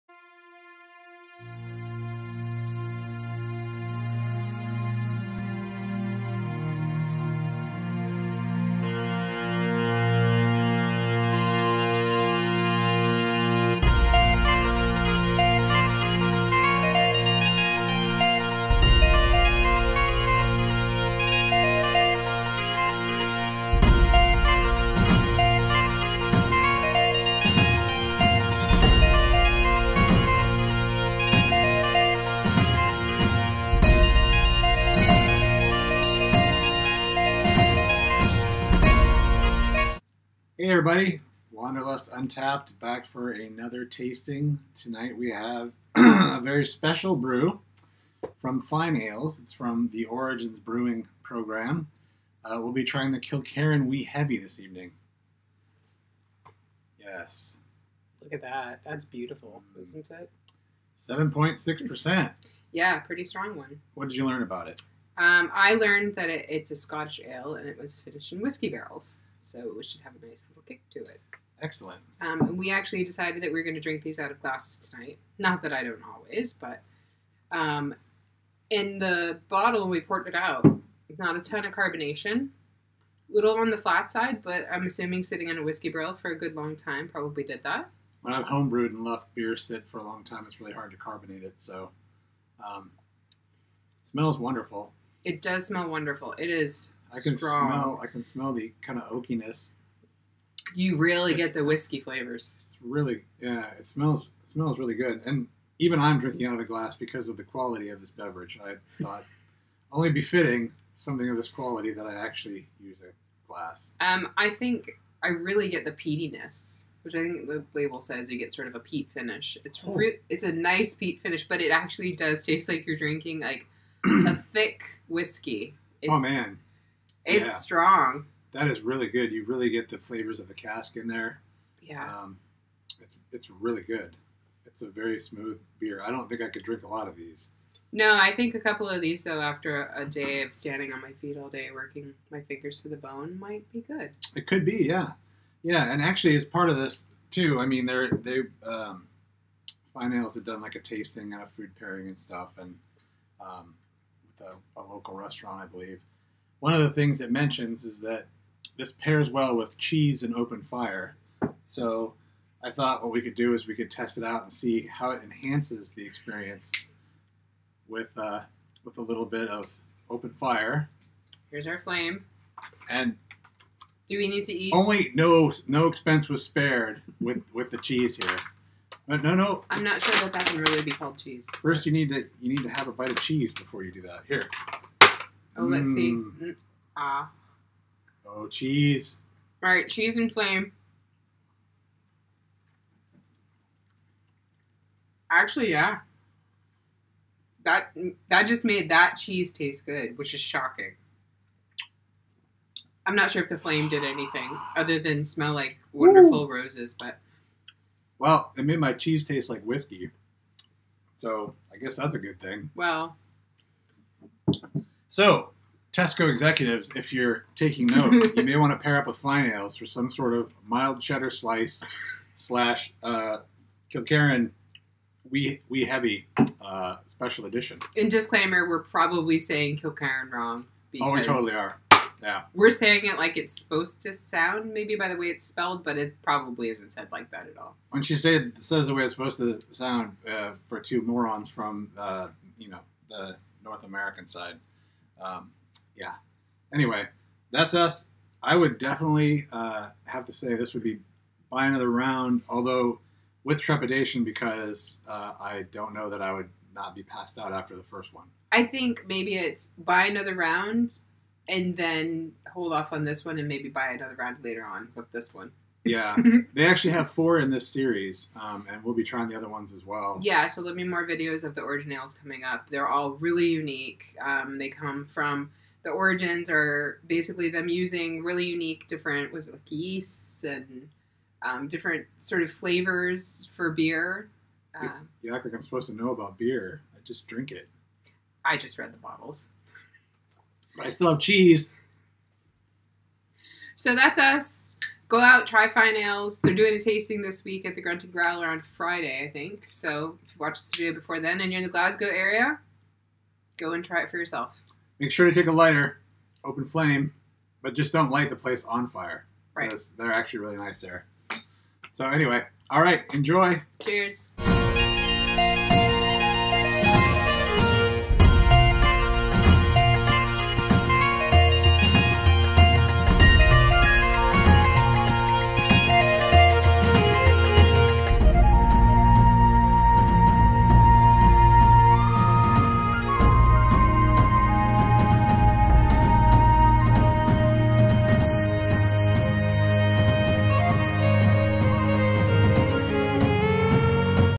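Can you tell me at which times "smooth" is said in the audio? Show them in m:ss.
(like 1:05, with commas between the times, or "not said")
2:15.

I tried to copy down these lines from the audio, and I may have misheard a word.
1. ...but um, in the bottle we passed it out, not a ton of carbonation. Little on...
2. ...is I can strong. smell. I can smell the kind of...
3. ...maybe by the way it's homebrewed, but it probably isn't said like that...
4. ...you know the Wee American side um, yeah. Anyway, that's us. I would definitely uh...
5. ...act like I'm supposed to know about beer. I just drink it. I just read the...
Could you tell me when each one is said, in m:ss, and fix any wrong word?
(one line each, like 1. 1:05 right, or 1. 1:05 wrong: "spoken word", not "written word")
1. 1:16 wrong: "poured", not "passed"
2. 1:36 right
3. 3:54 wrong: "spelled", not "homebrewed"
4. 4:02 wrong: "North", not "Wee"
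5. 4:45 right.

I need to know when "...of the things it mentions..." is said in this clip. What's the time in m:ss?
2:36.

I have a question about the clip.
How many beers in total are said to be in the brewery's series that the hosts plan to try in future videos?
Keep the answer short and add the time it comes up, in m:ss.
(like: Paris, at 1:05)
4, at 4:27.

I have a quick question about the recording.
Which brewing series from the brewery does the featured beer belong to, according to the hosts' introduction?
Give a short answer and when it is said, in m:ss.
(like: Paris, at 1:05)
Origins Brewing Program, at 0:50.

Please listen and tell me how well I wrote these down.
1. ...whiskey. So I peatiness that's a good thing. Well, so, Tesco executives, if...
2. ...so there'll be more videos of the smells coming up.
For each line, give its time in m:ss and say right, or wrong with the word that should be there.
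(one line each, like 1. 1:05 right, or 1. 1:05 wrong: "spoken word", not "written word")
1. 3:29 wrong: "guess", not "peatiness"
2. 4:30 wrong: "originals", not "smells".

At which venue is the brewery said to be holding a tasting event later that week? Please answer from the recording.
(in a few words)
Grunting Growler.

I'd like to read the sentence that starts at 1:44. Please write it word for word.
It smells really good, and even I'm drinking out of a glass because of the quality of this beverage.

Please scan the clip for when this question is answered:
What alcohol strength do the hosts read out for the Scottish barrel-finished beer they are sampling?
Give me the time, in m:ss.
1:00.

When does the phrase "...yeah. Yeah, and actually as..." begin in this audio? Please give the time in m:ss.
2:24.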